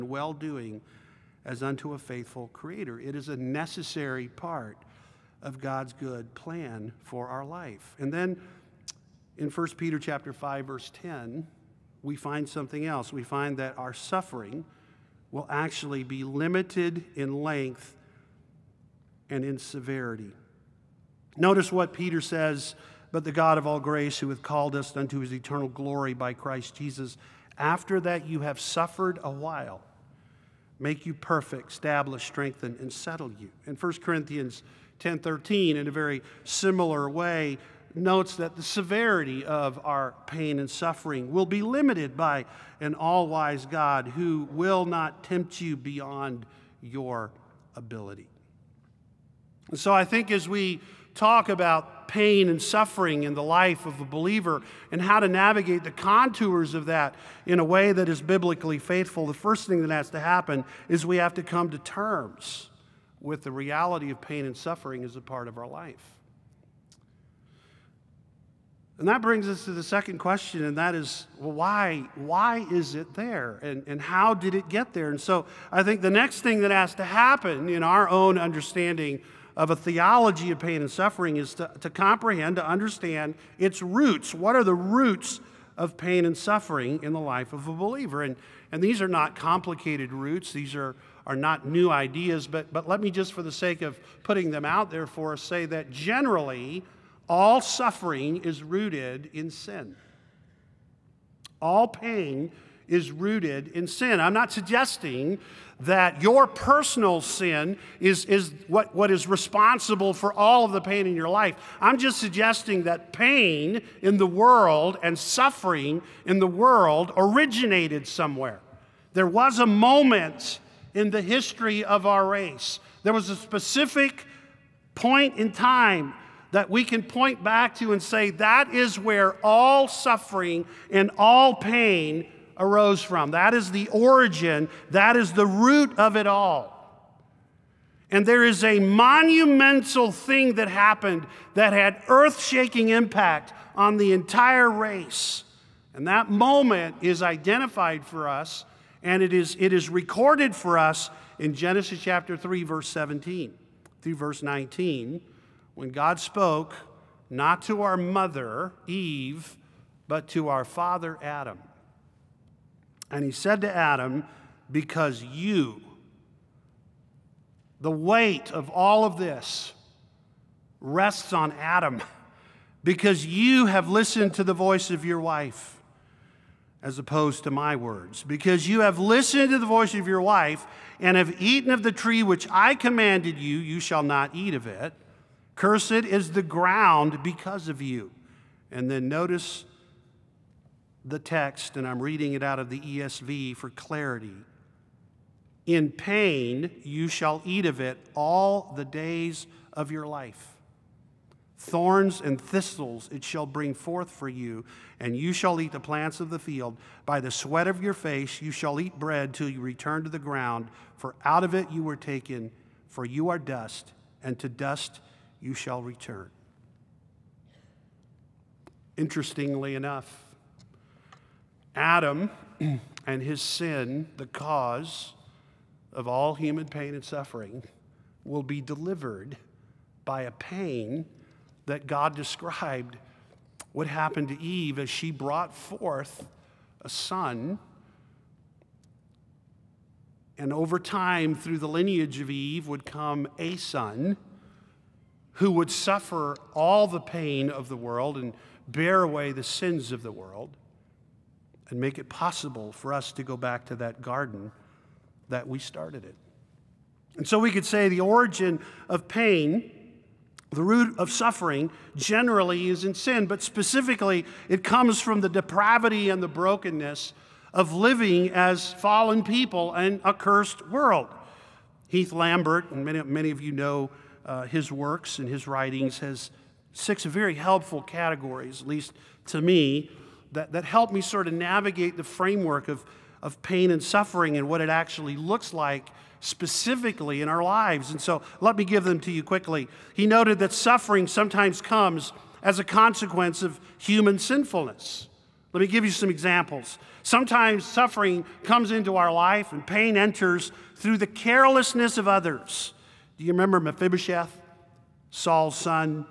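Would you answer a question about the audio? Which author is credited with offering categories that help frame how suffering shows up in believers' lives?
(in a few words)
Heath Lambert.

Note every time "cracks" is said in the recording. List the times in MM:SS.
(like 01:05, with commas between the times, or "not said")
not said.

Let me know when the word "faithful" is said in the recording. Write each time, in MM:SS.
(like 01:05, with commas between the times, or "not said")
00:01, 00:58.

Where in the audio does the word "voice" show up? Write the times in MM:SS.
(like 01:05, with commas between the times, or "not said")
02:54, 02:59.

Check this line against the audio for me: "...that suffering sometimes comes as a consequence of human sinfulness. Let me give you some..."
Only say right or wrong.
right.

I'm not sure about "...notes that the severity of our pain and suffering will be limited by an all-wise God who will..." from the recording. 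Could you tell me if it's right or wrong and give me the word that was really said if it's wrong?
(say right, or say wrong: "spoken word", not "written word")
right.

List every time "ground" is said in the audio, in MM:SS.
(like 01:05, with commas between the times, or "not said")
03:06, 03:30.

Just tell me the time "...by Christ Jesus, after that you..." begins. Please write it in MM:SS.
00:26.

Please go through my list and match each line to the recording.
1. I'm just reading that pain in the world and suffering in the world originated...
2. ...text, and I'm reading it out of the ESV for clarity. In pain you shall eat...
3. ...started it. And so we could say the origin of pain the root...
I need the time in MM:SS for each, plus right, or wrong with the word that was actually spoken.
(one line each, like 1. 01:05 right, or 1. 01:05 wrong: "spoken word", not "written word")
1. 01:51 wrong: "suggesting", not "reading"
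2. 03:11 right
3. 04:15 right.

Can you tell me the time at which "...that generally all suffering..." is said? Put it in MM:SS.
01:35.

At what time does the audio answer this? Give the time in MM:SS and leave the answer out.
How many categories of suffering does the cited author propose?
04:36.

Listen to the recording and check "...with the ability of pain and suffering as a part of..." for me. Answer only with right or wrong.
wrong.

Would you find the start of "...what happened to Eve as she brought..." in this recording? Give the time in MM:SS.
03:53.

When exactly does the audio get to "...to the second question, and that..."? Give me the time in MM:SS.
01:09.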